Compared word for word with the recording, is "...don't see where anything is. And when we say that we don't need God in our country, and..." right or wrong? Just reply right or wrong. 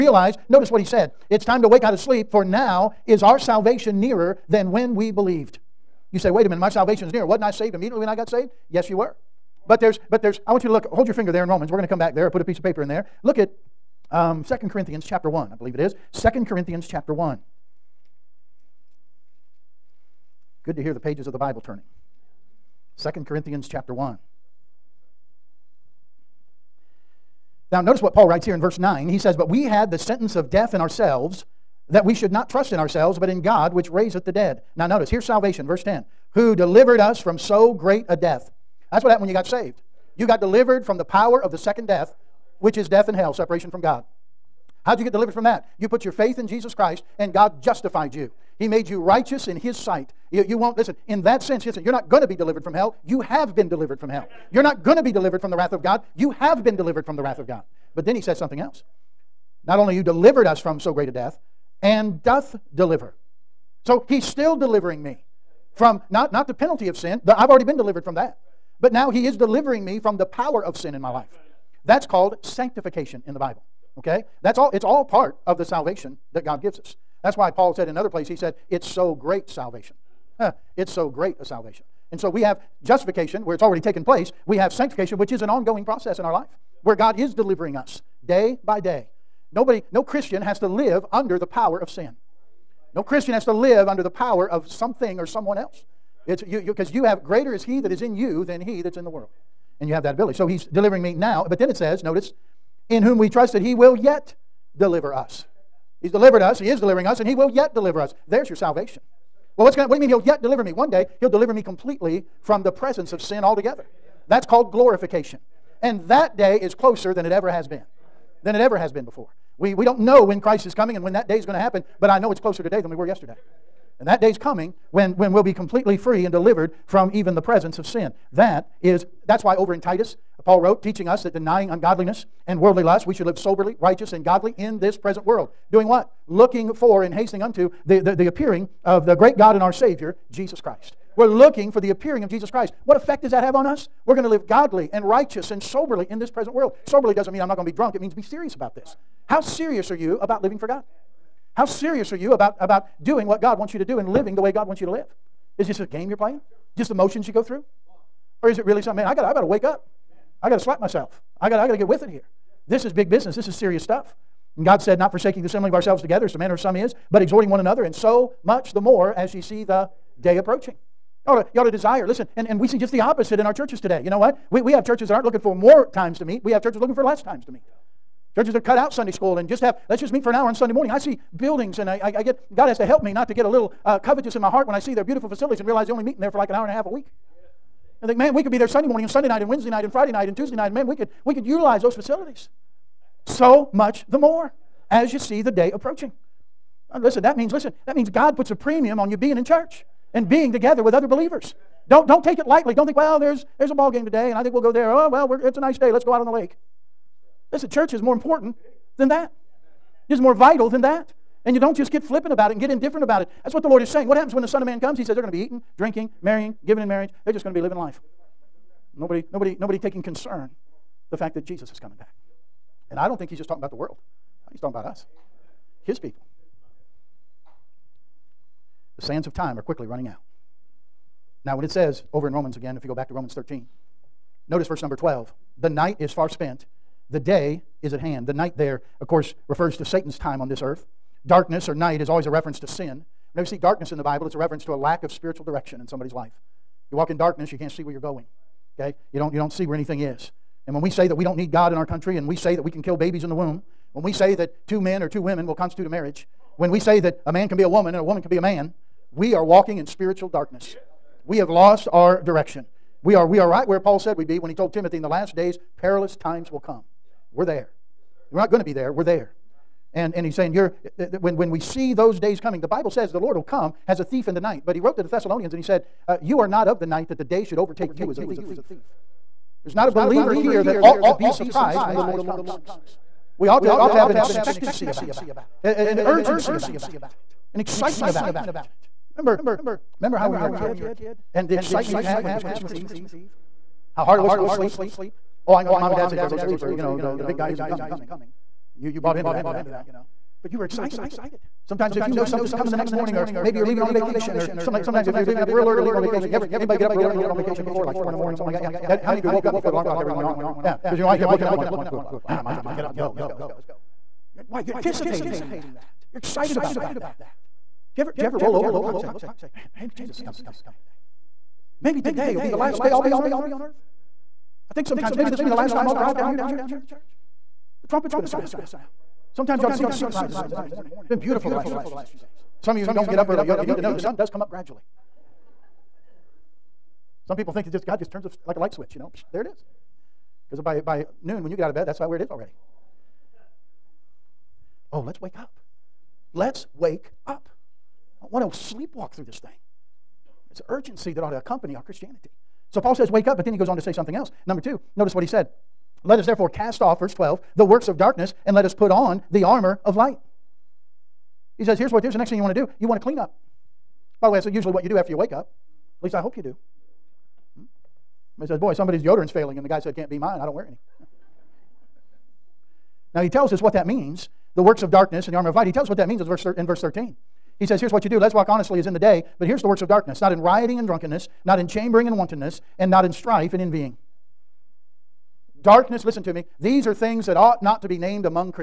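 right.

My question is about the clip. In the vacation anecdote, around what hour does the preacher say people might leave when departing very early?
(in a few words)
4 in the morning.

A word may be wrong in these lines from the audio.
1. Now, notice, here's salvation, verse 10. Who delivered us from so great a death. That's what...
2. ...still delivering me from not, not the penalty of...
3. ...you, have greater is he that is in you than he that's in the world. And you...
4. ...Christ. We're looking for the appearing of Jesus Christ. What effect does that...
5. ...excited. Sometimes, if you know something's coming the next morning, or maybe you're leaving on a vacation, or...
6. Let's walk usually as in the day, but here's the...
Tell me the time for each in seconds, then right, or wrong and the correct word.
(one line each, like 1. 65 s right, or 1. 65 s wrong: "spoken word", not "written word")
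1. 34 s right
2. 64 s right
3. 96 s right
4. 140 s right
5. 300 s right
6. 378 s wrong: "honestly", not "usually".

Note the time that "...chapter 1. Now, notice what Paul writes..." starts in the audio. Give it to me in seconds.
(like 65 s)
23 s.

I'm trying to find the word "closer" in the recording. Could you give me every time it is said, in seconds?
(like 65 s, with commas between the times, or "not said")
116 s, 122 s.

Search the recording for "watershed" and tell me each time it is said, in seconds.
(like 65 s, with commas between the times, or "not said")
not said.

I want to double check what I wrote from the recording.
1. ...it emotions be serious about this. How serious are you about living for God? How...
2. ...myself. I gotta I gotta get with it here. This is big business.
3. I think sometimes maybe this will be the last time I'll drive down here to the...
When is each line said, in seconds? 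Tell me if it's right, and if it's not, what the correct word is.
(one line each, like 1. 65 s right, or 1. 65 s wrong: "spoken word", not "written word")
1. 147 s wrong: "means", not "emotions"
2. 160 s right
3. 324 s right.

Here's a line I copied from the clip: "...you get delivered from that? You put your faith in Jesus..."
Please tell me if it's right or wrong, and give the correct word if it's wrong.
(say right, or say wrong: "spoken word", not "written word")
right.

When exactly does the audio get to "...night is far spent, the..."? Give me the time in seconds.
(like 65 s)
235 s.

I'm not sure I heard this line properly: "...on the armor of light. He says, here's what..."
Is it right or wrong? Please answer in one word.
right.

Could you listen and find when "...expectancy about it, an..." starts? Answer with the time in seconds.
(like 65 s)
284 s.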